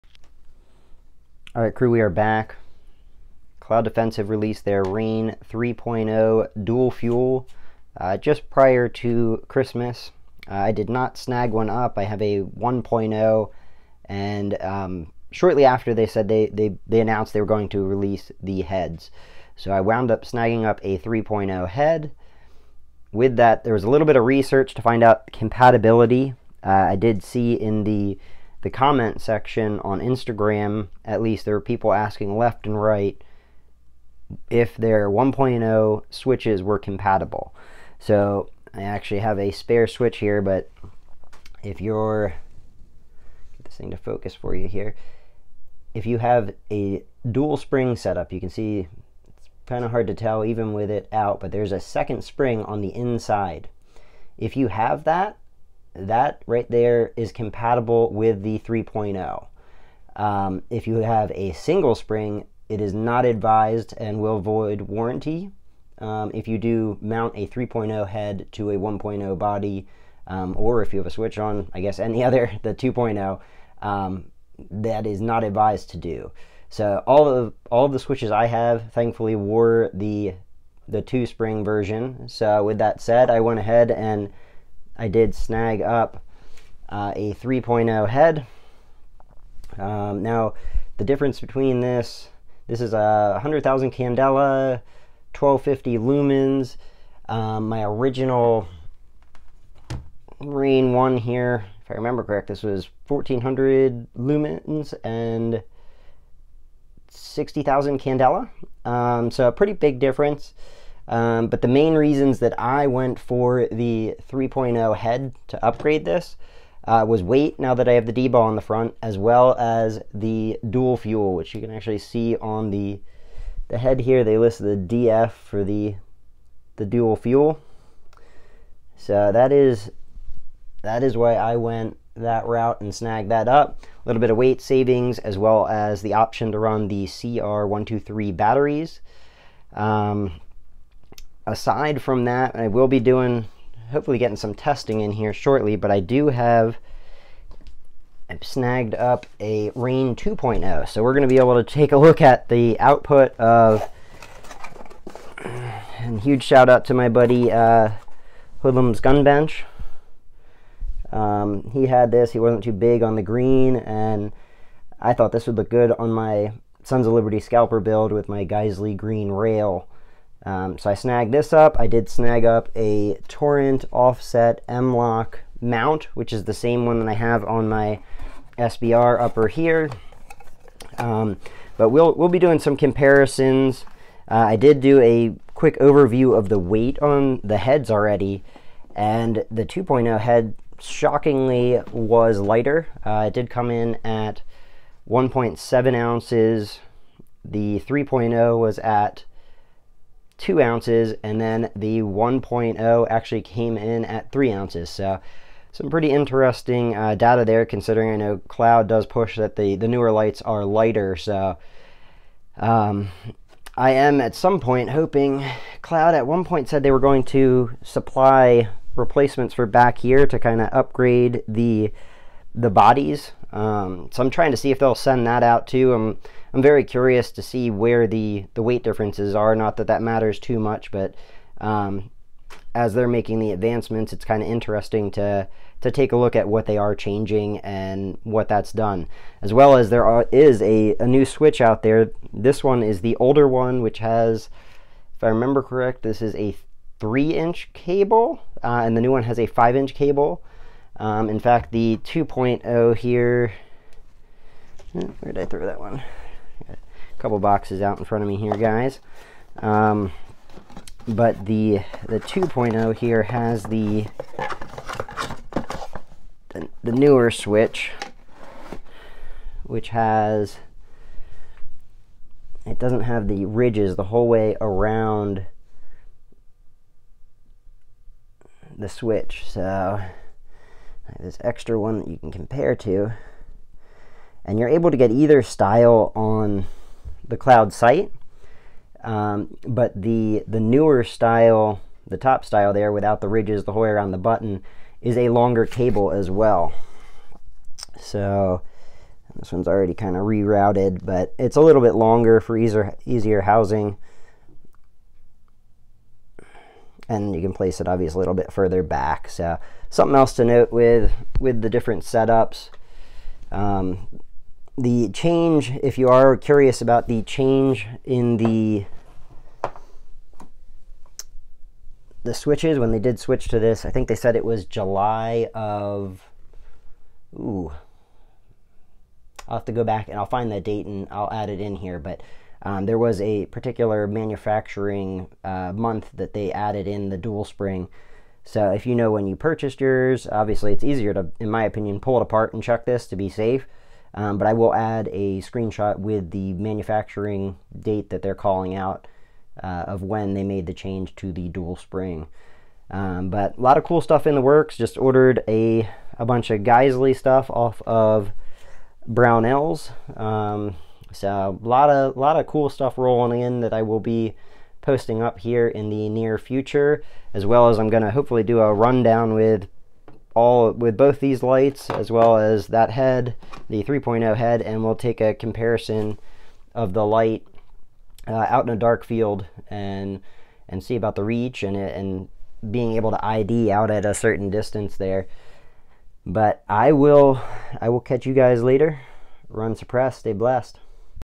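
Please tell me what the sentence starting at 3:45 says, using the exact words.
I'm I'm very curious to see where the the weight differences are.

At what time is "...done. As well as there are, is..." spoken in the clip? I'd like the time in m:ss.
3:58.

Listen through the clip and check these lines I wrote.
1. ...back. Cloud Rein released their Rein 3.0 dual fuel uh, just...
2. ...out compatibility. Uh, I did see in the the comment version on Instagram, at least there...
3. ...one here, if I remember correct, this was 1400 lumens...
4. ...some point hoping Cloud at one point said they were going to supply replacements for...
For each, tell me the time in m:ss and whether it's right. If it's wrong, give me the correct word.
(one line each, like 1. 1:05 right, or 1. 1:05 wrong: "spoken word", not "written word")
1. 0:02 wrong: "Defensive", not "Rein"
2. 0:25 wrong: "section", not "version"
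3. 1:40 right
4. 3:34 right.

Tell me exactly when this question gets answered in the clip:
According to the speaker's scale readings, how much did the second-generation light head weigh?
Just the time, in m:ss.
3:15.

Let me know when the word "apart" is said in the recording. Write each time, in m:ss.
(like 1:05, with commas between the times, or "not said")
5:42.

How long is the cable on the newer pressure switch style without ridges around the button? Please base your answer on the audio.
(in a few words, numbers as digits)
5 inches.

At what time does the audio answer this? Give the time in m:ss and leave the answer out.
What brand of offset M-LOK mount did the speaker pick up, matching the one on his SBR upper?
2:53.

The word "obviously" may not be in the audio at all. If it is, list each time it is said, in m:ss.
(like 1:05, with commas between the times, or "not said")
5:07, 5:40.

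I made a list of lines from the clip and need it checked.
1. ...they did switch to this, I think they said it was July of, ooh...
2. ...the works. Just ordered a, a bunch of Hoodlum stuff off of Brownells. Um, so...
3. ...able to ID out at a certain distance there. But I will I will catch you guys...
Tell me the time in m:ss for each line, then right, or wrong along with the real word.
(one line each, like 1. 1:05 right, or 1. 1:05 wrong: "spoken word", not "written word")
1. 5:22 right
2. 5:54 wrong: "Geissele", not "Hoodlum"
3. 6:22 right.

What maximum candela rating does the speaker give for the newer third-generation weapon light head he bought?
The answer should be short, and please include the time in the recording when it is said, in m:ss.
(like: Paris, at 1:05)
100,000, at 1:33.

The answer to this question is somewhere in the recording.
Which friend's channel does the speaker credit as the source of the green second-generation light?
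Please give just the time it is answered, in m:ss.
2:38.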